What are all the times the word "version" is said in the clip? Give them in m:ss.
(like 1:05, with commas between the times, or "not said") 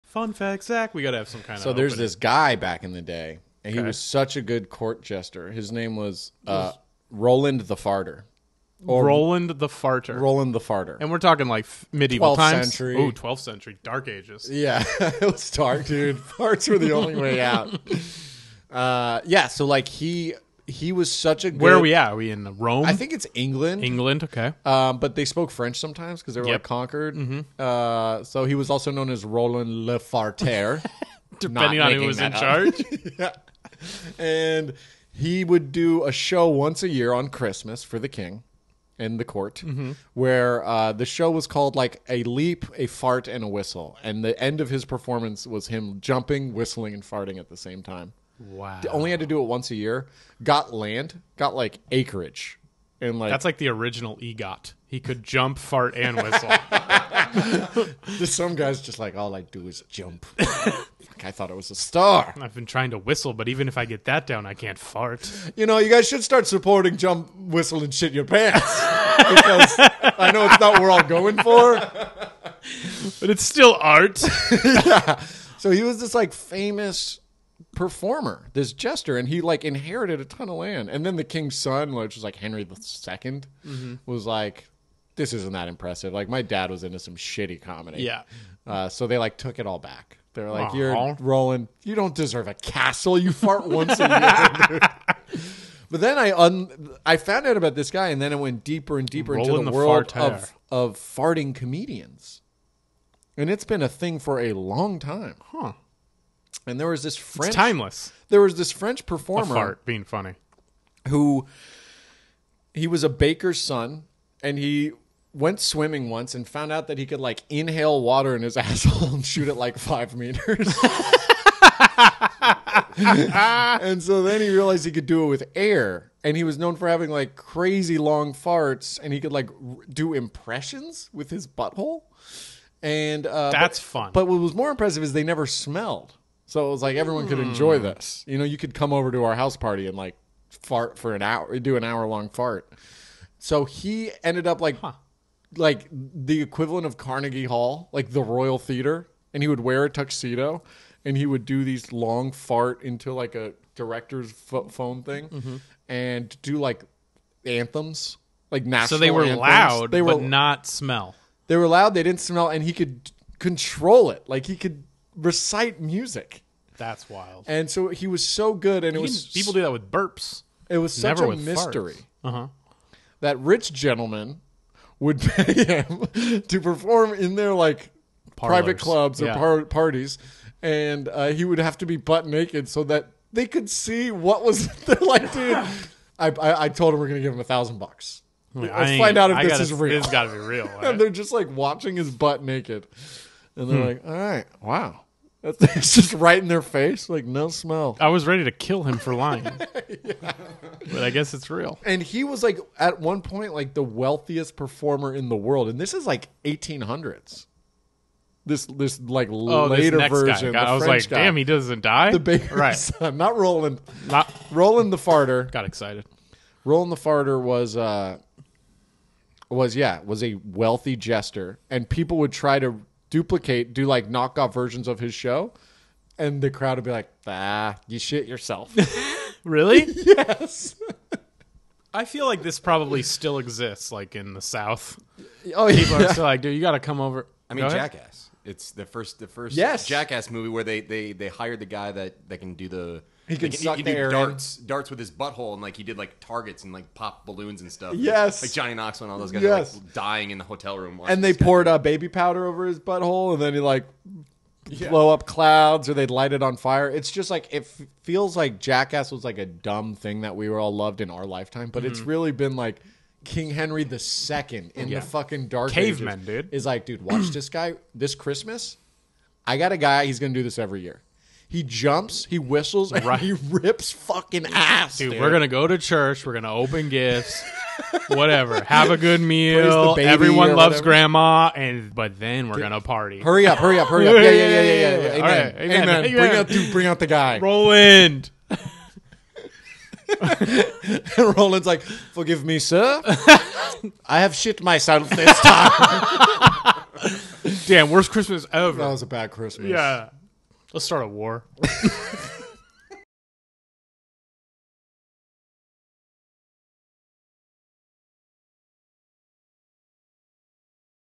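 3:30, 3:44.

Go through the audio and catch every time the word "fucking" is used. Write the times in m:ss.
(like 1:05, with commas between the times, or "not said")
4:25, 4:33.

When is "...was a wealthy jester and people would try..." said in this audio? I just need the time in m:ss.
3:40.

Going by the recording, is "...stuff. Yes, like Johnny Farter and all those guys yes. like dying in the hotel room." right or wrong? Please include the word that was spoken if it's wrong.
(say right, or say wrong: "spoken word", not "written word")
wrong: "Knoxville", not "Farter".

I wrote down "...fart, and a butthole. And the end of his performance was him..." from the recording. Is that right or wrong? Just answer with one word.
wrong.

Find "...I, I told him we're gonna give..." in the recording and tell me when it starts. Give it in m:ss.
3:06.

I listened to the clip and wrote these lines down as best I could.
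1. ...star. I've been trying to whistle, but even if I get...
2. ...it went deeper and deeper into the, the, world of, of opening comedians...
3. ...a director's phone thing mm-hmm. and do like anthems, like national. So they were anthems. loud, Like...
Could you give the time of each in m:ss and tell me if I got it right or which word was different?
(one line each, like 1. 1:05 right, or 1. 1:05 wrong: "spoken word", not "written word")
1. 1:01 right
2. 1:38 wrong: "farting", not "opening"
3. 2:33 wrong: "They", not "Like".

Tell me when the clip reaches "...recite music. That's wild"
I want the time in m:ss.
2:45.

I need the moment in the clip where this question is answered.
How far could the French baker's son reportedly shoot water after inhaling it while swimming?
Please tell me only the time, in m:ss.
1:59.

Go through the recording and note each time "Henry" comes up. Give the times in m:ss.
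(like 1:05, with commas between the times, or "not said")
1:22, 4:23.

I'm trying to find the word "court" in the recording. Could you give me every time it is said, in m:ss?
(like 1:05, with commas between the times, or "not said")
0:04, 0:39.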